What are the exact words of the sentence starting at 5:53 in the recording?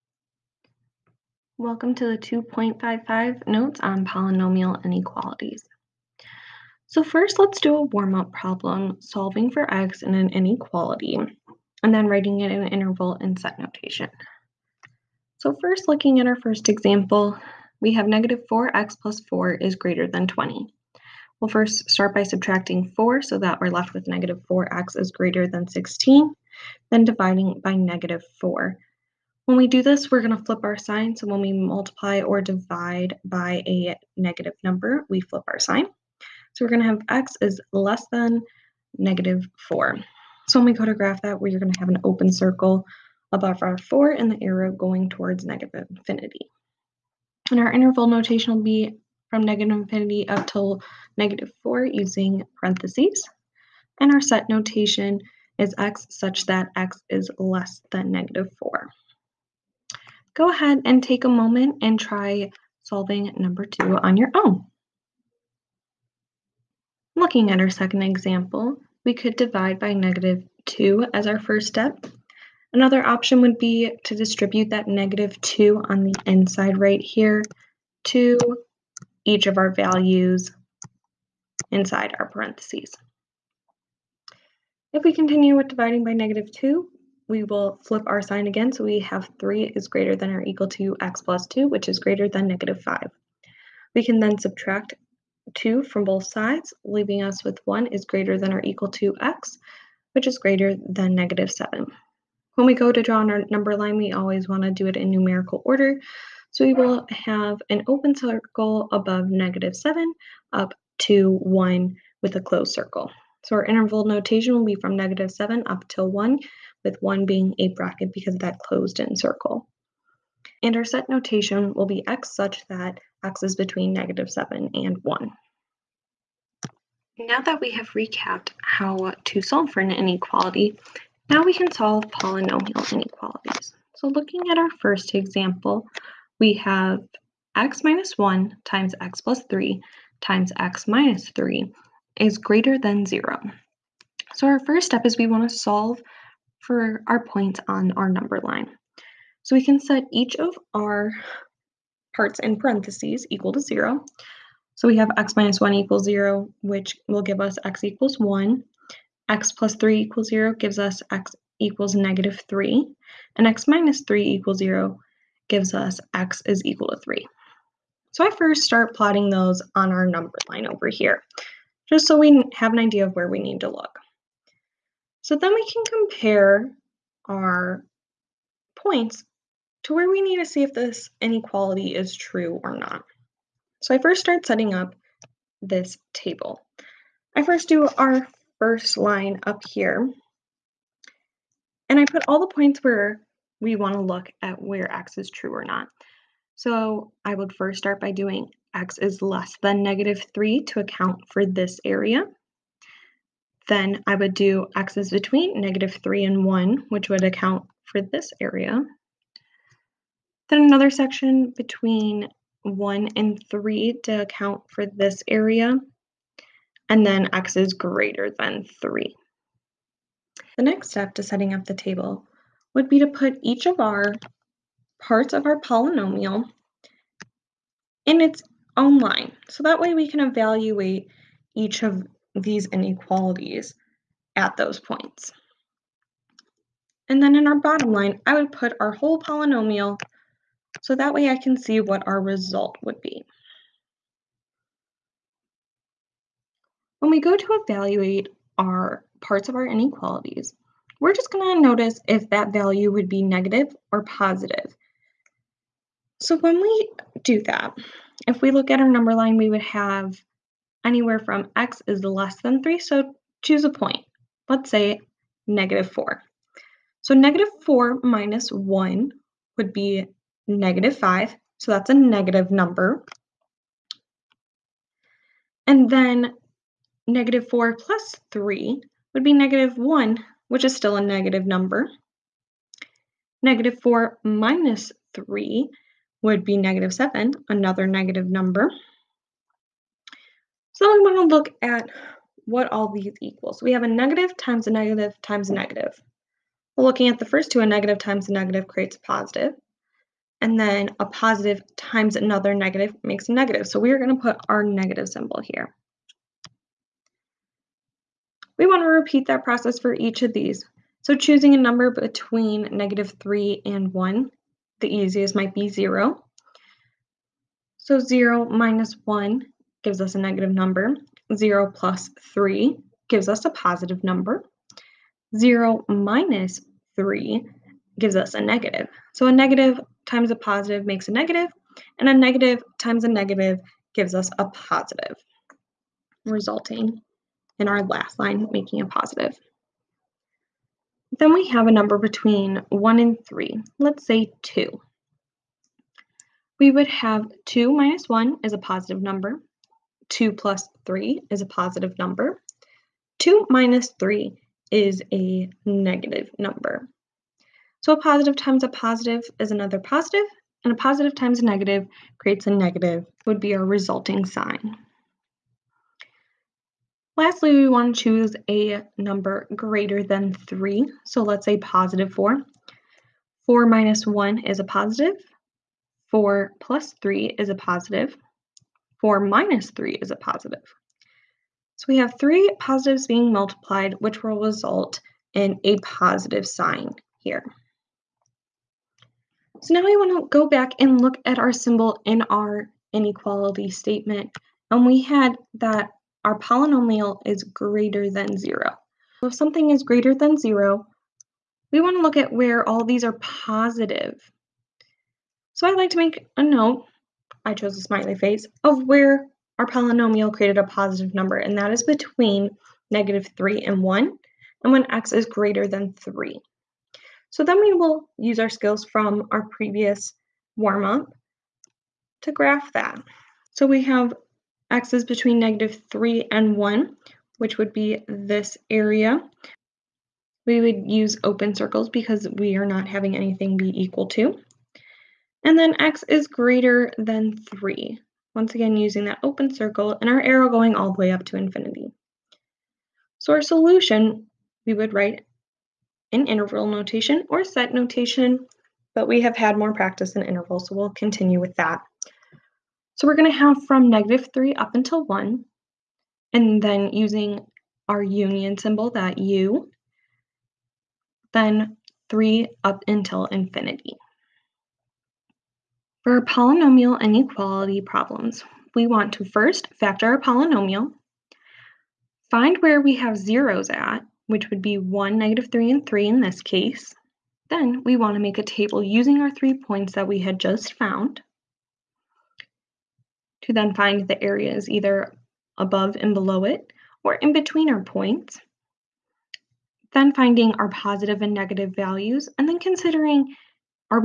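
2 minus 3 is a negative number.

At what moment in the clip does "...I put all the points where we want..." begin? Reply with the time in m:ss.
3:11.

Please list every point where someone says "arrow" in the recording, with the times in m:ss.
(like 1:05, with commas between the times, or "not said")
0:44, 7:20.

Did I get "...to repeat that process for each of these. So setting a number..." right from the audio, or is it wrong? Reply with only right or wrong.
wrong.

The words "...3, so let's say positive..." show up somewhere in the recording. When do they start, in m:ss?
6:10.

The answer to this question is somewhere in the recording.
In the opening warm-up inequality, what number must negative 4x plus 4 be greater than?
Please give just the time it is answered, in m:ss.
0:20.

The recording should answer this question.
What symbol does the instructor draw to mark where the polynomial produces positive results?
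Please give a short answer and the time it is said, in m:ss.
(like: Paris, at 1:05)
A smiley face, at 6:47.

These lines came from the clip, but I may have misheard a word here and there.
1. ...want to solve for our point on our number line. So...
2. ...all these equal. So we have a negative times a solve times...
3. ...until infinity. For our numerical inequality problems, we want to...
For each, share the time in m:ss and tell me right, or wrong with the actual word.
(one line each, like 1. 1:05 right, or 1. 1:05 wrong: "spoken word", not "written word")
1. 2:25 right
2. 4:52 wrong: "negative", not "solve"
3. 7:42 wrong: "polynomial", not "numerical".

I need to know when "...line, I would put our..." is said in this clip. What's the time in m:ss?
3:57.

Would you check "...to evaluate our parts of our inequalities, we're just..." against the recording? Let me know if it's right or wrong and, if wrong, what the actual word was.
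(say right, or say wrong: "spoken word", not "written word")
right.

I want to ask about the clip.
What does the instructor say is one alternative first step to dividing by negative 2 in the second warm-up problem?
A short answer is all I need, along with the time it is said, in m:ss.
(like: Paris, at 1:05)
Distribute the negative 2, at 1:14.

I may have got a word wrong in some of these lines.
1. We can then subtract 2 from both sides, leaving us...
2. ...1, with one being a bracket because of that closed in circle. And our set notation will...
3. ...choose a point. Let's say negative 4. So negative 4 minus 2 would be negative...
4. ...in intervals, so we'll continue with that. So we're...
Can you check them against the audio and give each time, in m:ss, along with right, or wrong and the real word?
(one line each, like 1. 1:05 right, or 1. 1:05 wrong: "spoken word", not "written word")
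1. 1:33 right
2. 1:56 right
3. 4:23 wrong: "1", not "2"
4. 7:30 right.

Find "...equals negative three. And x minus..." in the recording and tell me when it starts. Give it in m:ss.
2:41.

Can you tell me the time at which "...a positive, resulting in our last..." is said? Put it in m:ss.
5:34.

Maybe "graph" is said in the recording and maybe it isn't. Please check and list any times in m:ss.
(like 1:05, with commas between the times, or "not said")
0:40, 7:02.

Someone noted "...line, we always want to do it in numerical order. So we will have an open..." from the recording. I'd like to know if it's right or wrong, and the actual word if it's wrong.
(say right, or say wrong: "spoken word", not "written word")
right.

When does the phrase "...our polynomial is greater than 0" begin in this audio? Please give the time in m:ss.
6:36.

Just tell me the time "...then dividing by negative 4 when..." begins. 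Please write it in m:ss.
0:26.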